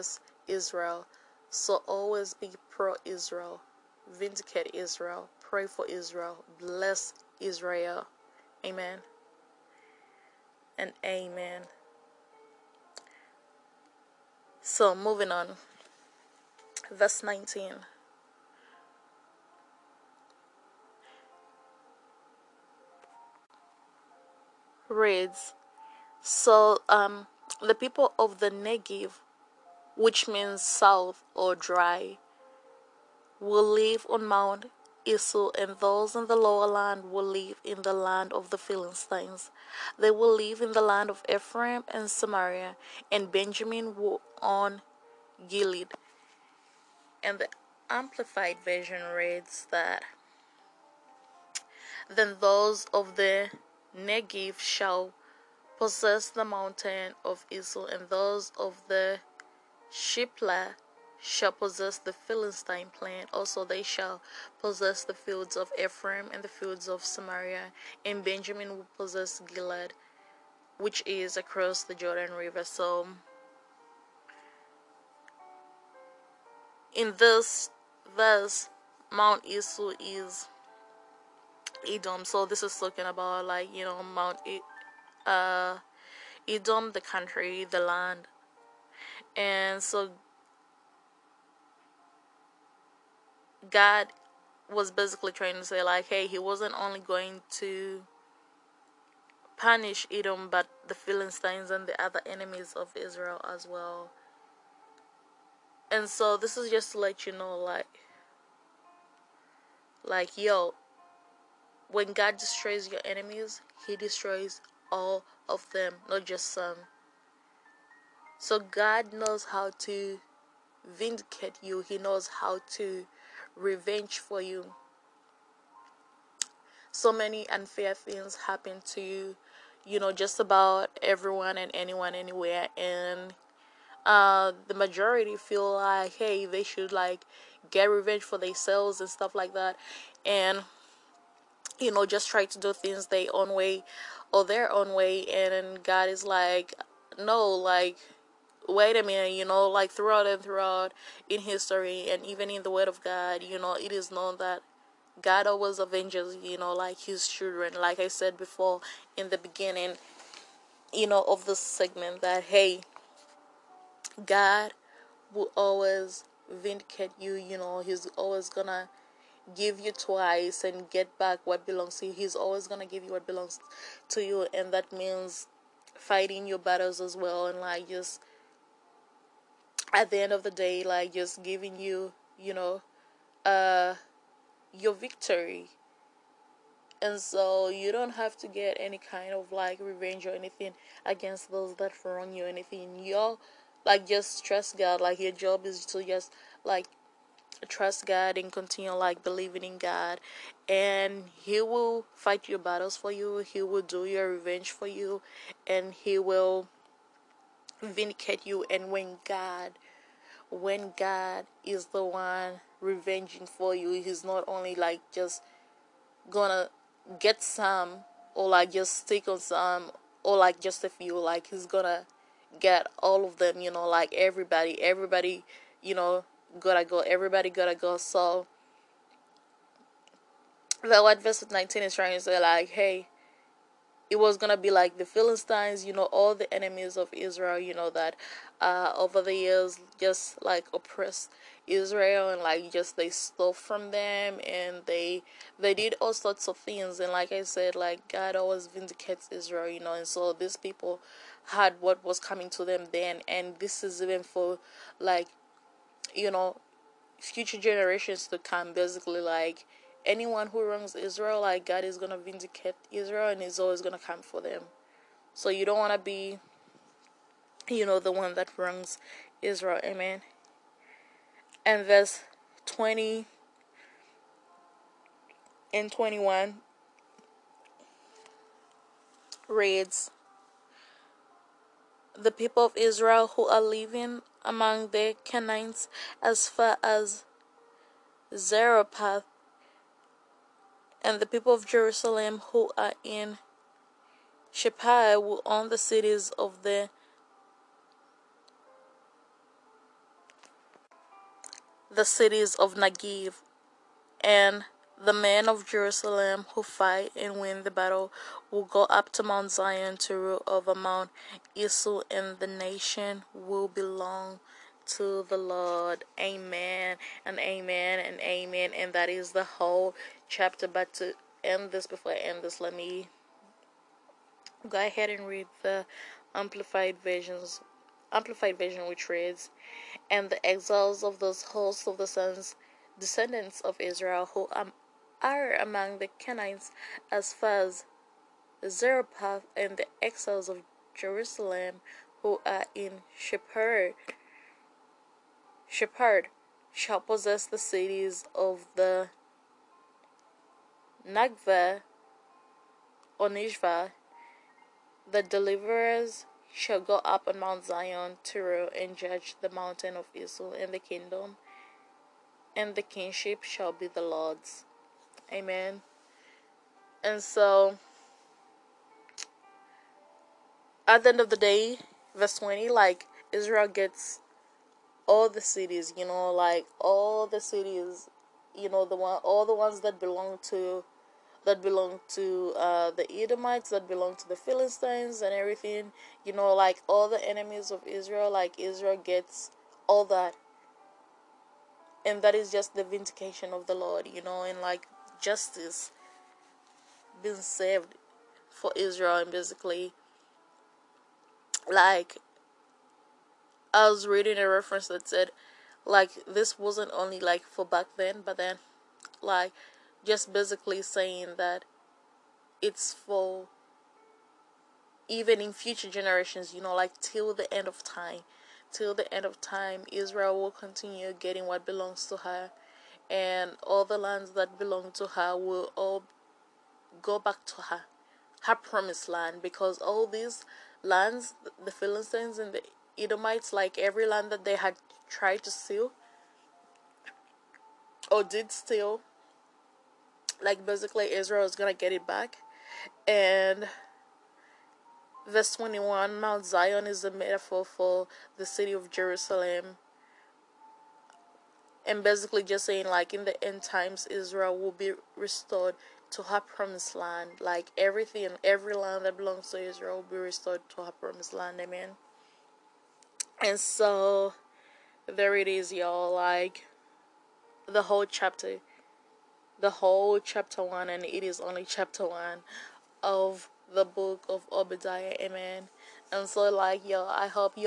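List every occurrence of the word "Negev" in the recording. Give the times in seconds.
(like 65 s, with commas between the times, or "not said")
28 s, 53 s, 302 s.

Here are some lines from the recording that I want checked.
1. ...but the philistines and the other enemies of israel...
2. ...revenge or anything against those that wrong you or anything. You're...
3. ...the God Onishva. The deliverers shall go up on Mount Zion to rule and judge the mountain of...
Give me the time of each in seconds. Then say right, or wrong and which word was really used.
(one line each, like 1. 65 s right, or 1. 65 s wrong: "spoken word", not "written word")
1. 100 s right
2. 189 s right
3. 348 s wrong: "Nagva", not "God".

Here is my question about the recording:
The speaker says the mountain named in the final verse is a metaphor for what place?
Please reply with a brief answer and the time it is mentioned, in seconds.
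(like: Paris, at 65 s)
The city of Jerusalem, at 448 s.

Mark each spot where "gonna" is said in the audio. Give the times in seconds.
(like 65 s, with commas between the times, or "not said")
168 s, 172 s, 216 s, 221 s, 234 s, 441 s.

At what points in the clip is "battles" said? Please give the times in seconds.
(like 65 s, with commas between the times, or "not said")
176 s, 202 s, 307 s.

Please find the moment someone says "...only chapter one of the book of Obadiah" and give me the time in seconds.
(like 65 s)
471 s.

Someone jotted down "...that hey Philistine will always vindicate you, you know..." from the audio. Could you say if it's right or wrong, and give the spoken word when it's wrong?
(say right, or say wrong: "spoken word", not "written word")
wrong: "God", not "Philistine".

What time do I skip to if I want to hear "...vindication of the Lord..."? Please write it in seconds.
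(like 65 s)
392 s.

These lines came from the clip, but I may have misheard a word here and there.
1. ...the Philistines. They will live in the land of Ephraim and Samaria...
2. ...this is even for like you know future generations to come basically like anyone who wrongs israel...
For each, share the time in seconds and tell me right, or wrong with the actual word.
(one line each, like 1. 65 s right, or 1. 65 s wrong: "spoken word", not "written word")
1. 38 s right
2. 253 s right.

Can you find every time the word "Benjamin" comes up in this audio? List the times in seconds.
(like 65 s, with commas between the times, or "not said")
43 s, 68 s.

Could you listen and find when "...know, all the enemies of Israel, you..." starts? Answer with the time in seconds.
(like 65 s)
235 s.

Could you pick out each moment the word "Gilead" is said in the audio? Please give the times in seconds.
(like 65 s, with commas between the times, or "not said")
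45 s, 69 s.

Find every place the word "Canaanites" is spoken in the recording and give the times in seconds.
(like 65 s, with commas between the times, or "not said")
285 s, 336 s.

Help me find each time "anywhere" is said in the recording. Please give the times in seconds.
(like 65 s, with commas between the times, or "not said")
132 s.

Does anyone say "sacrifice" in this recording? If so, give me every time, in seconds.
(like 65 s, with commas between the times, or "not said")
not said.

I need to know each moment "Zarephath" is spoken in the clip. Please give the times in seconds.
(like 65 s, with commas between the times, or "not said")
288 s, 338 s.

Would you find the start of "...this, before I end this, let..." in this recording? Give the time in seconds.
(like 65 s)
321 s.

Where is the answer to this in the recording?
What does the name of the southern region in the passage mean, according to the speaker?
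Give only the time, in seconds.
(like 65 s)
30 s.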